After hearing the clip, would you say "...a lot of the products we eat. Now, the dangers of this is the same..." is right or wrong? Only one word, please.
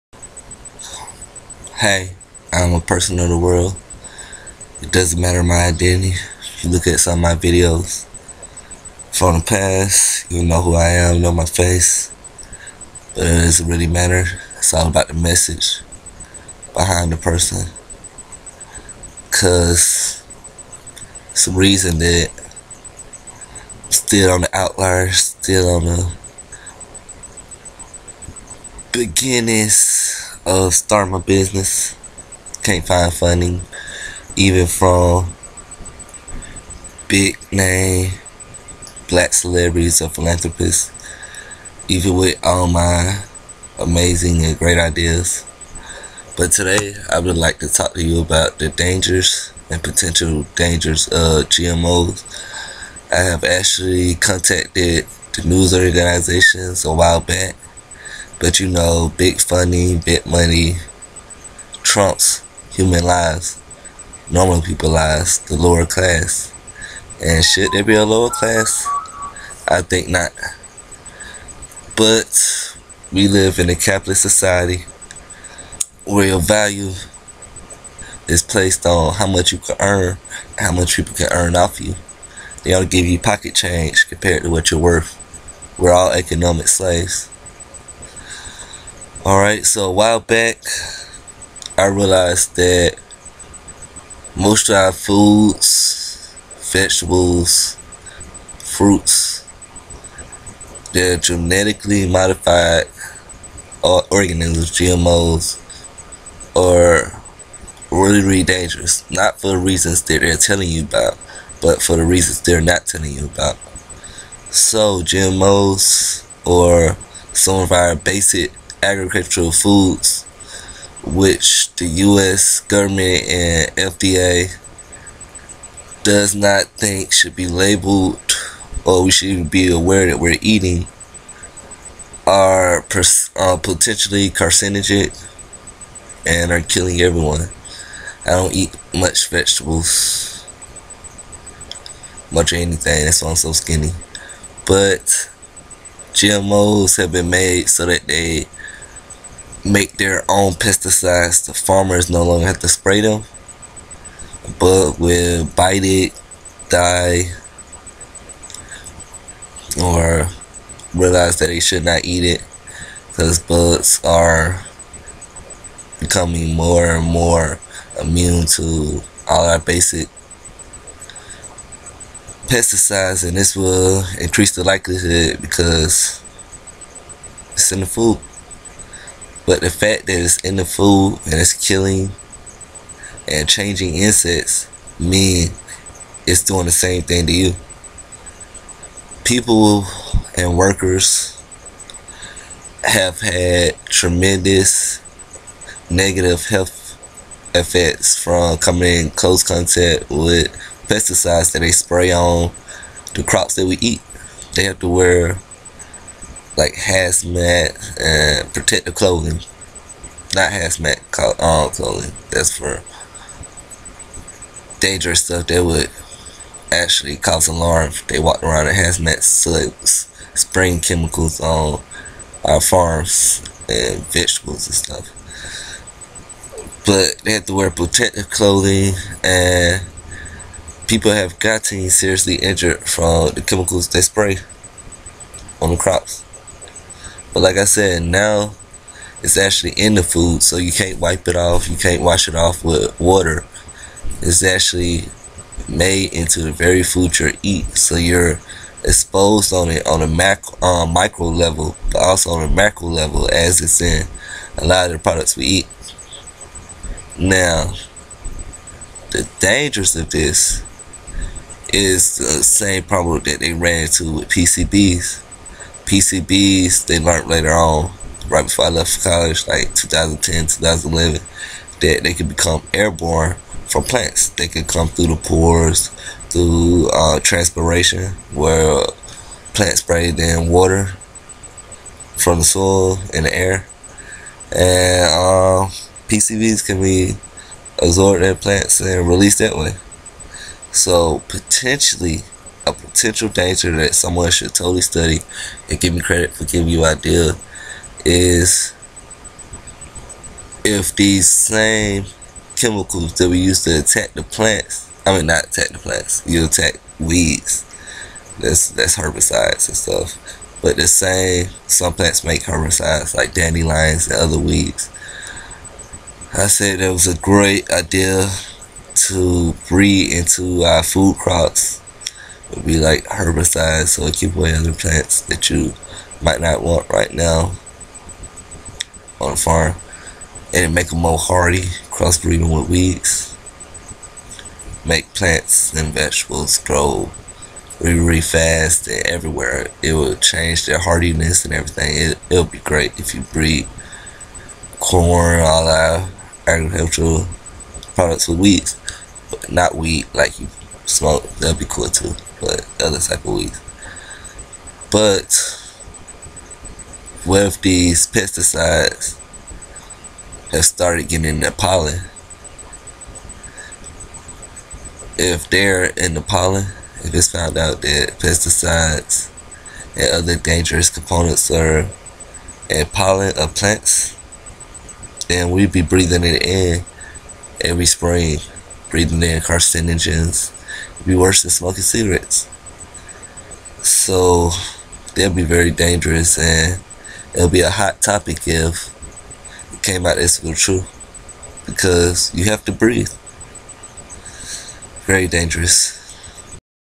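right.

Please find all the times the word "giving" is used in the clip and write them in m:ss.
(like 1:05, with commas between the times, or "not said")
4:56.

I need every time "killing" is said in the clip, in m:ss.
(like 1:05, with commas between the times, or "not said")
2:16, 3:01.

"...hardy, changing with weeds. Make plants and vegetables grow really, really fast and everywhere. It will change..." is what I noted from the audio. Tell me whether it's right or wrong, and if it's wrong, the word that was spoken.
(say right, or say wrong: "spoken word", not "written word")
wrong: "crossbreeding", not "changing".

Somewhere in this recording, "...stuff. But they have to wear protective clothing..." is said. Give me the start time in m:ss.
3:44.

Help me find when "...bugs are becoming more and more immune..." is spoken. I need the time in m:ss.
2:43.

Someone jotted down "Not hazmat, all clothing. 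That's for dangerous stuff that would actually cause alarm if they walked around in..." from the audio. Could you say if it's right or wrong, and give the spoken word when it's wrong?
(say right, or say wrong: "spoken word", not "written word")
right.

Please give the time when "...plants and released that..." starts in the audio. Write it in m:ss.
4:48.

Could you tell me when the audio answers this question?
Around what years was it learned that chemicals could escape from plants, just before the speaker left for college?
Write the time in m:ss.
4:29.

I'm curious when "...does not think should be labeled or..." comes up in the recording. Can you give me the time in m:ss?
2:06.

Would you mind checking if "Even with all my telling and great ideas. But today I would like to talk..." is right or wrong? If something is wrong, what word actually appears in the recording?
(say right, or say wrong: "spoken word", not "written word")
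wrong: "amazing", not "telling".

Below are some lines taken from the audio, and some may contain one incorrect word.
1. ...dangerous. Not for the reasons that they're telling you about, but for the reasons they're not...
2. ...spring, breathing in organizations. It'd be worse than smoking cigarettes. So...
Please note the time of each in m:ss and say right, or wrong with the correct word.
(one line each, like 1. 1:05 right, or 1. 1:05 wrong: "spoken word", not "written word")
1. 1:48 right
2. 6:17 wrong: "carcinogens", not "organizations".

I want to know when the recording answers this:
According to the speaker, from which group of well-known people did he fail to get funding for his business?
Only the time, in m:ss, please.
0:37.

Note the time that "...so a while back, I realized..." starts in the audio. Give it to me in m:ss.
1:29.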